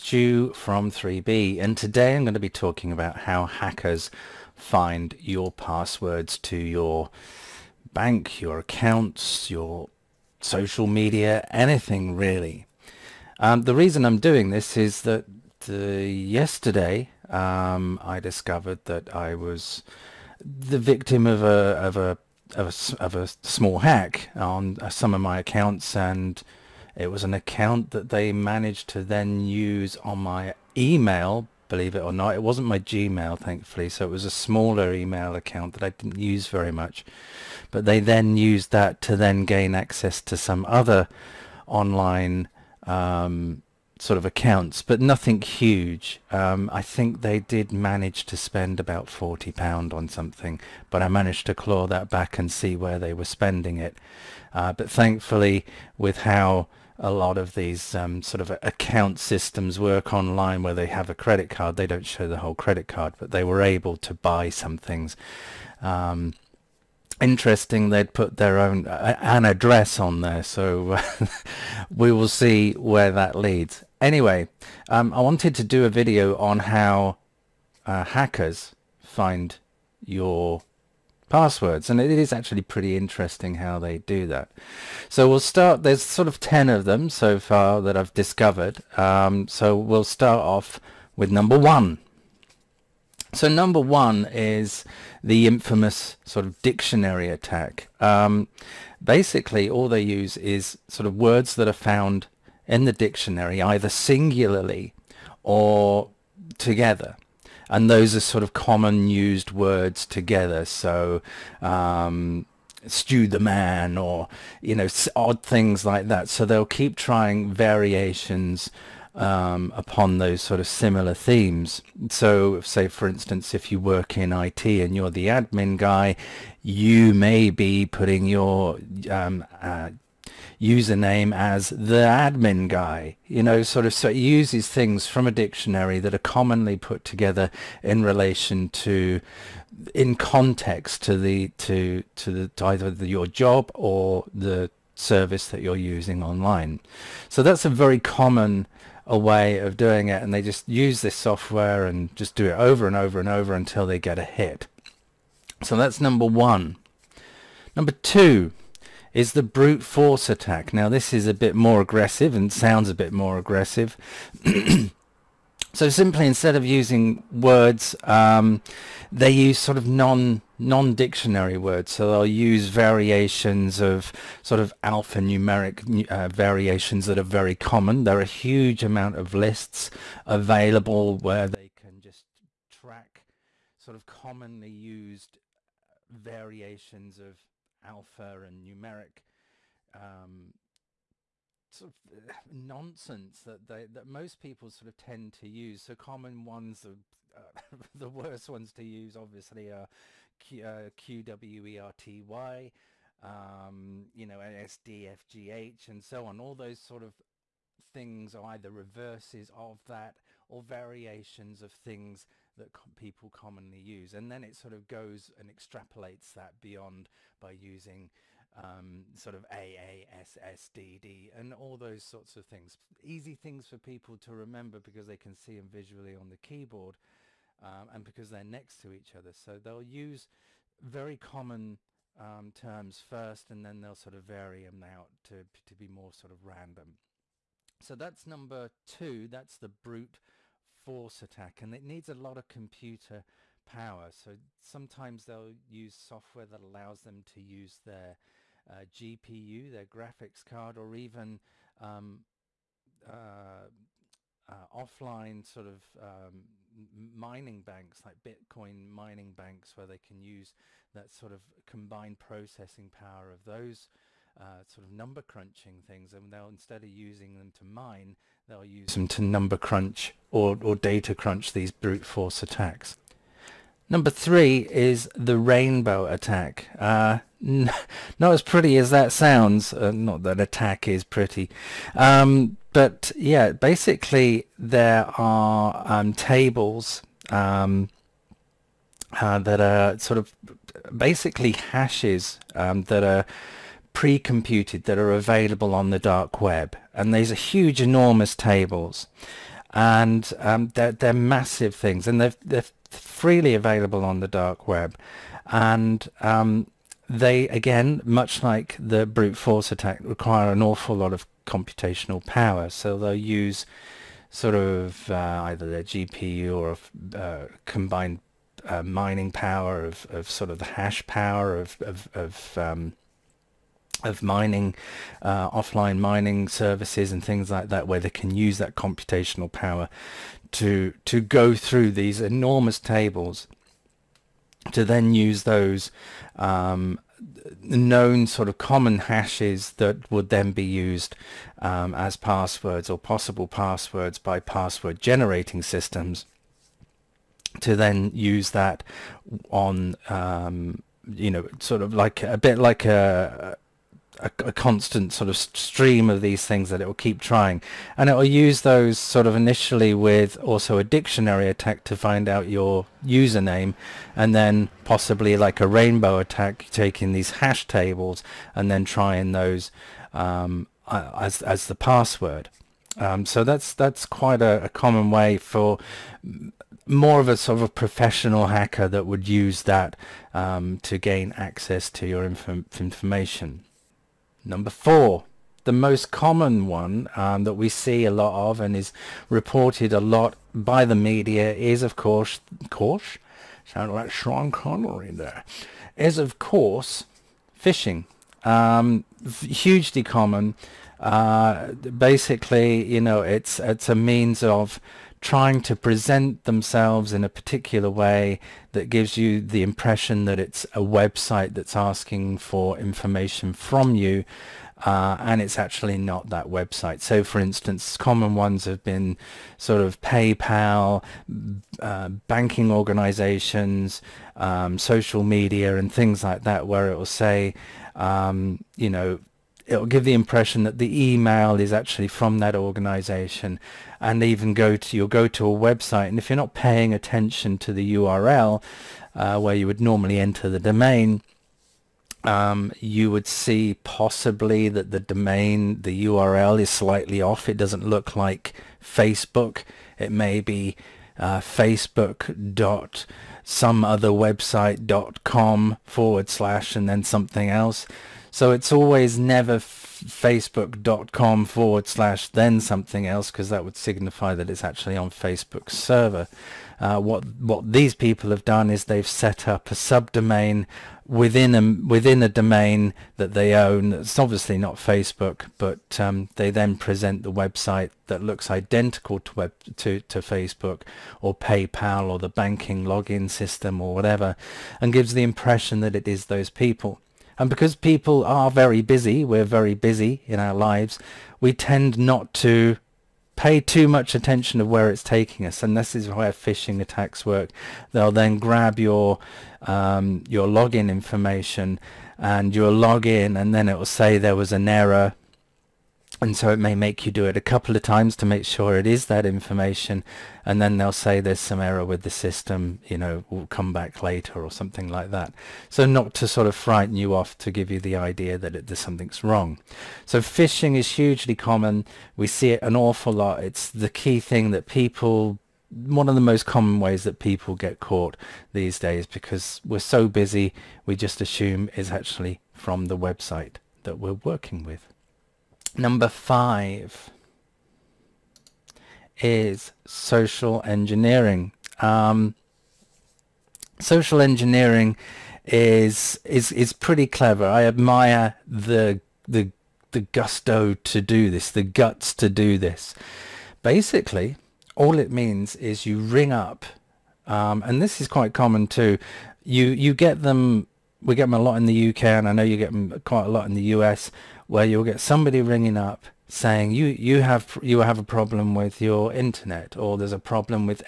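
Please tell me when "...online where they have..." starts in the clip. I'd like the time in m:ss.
1:00.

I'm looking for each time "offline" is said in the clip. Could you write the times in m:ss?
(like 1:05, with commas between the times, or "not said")
4:14, 5:25.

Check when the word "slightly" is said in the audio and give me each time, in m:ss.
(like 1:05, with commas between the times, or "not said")
7:26.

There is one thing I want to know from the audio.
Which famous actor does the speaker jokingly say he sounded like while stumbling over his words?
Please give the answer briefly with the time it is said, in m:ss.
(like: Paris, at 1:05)
Sean Connery, at 6:34.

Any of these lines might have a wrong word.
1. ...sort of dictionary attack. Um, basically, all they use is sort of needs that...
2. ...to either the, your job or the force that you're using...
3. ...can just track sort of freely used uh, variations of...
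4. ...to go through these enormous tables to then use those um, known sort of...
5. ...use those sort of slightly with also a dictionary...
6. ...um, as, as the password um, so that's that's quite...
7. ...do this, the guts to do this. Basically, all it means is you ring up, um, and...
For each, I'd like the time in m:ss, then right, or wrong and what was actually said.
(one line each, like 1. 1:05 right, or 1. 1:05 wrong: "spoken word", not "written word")
1. 1:36 wrong: "words", not "needs"
2. 2:22 wrong: "service", not "force"
3. 3:01 wrong: "commonly", not "freely"
4. 5:31 right
5. 5:58 wrong: "initially", not "slightly"
6. 6:10 right
7. 9:11 right.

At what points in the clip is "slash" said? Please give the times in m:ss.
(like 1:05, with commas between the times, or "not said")
7:36, 7:41.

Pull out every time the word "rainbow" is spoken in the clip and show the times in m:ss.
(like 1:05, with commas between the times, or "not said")
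4:35, 6:05.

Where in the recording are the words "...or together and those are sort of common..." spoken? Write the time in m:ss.
1:45.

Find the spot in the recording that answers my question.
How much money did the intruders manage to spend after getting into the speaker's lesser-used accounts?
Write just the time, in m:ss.
0:49.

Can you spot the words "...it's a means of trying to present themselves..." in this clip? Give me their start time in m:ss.
6:43.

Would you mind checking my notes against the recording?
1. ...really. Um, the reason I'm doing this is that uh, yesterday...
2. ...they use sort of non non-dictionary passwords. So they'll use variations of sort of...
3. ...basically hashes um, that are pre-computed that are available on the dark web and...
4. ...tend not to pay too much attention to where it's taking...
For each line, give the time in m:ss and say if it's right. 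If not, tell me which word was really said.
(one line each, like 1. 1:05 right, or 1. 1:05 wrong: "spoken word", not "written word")
1. 0:12 right
2. 2:49 wrong: "words", not "passwords"
3. 4:50 right
4. 8:11 right.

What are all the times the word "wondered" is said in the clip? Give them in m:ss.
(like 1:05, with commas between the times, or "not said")
not said.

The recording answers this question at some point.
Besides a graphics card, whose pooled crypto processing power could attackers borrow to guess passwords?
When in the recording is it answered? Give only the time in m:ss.
4:18.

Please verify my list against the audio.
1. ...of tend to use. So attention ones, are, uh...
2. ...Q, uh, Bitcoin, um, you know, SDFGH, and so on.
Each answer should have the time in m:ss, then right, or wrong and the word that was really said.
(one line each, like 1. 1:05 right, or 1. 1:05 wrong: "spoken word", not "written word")
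1. 3:14 wrong: "common", not "attention"
2. 3:20 wrong: "QWERTY", not "Bitcoin".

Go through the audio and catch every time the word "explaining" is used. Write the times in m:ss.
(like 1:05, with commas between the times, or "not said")
not said.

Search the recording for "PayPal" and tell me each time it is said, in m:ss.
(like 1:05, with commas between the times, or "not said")
7:00, 8:01.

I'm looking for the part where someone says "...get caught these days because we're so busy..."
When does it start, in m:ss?
8:47.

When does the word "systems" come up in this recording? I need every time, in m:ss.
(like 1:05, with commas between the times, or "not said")
0:59, 5:45, 8:03, 8:32.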